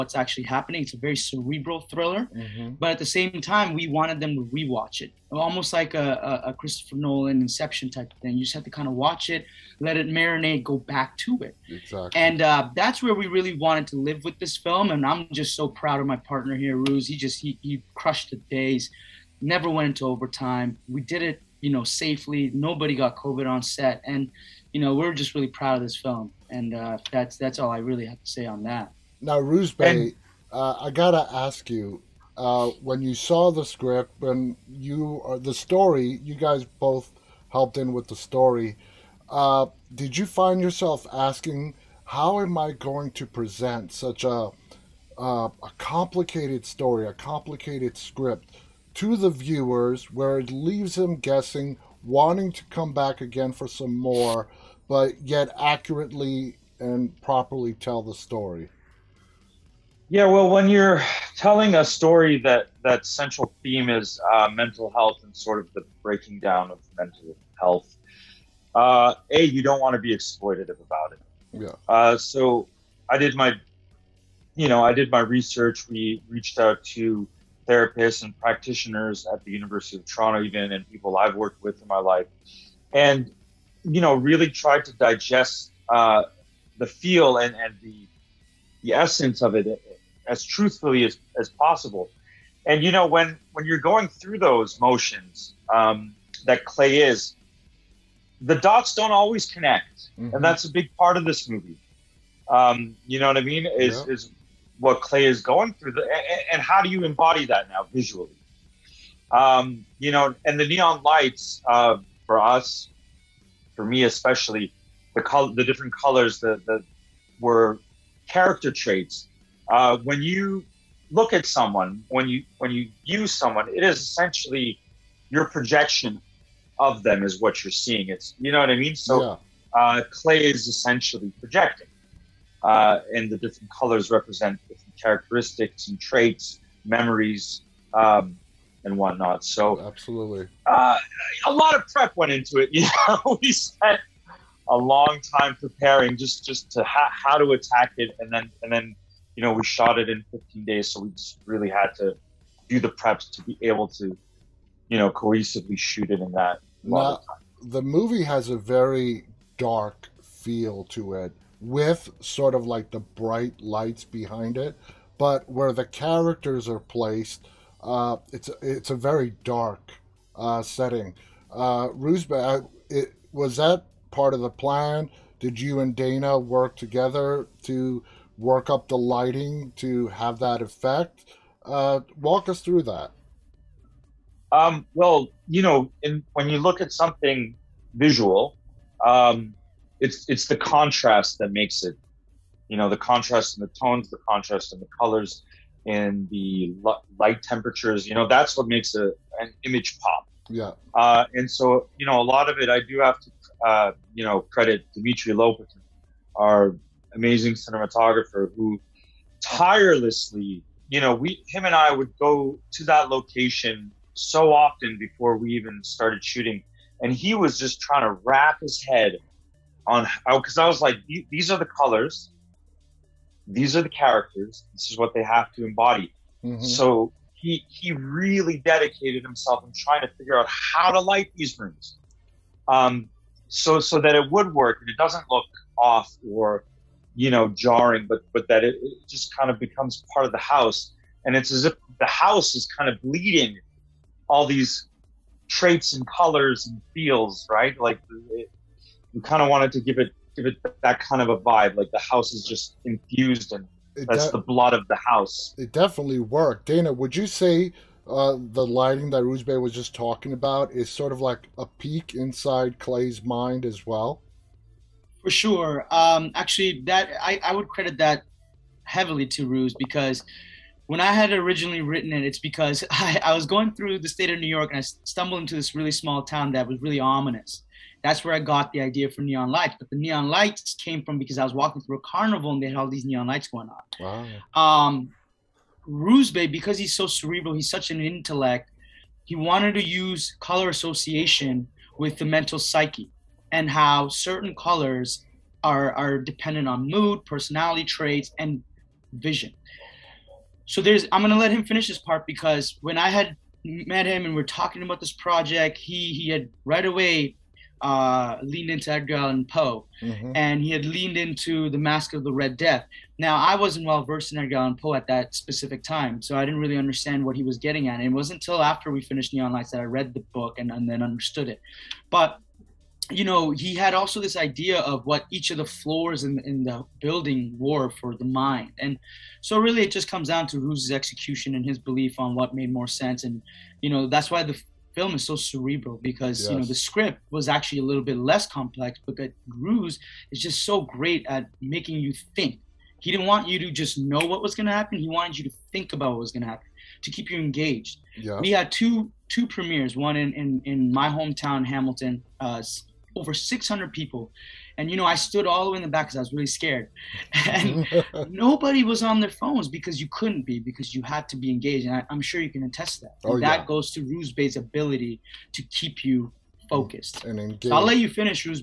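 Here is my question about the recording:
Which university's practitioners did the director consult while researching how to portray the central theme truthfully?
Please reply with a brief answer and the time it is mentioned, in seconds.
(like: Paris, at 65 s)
University of Toronto, at 79 s.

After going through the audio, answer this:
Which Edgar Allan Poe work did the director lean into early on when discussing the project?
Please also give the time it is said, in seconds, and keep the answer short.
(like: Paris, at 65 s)
The Masque of the Red Death, at 311 s.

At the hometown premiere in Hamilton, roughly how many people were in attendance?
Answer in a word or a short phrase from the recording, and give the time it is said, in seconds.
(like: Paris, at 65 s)
over 600, at 353 s.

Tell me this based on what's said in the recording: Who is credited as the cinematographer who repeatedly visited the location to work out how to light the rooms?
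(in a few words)
Dimitri Lopatin.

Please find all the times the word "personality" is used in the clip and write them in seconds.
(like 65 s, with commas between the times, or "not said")
297 s.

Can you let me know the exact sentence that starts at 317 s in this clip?
And it wasn't until after we finished Neon Lights that I read the book and, and then understood it.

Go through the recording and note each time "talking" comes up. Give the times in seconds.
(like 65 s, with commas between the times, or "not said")
259 s, 304 s.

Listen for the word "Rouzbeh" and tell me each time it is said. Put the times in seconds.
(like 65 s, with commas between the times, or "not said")
29 s, 171 s, 259 s, 364 s.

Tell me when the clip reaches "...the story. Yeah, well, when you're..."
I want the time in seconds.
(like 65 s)
58 s.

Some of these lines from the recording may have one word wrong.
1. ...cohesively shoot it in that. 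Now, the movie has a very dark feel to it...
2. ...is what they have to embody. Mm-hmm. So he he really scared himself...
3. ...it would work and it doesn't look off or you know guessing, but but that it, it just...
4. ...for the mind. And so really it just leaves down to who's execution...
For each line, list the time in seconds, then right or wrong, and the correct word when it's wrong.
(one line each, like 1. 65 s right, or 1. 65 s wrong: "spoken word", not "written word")
1. 155 s right
2. 224 s wrong: "dedicated", not "scared"
3. 234 s wrong: "jarring", not "guessing"
4. 327 s wrong: "comes", not "leaves".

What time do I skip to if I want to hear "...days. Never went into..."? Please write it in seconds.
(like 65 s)
18 s.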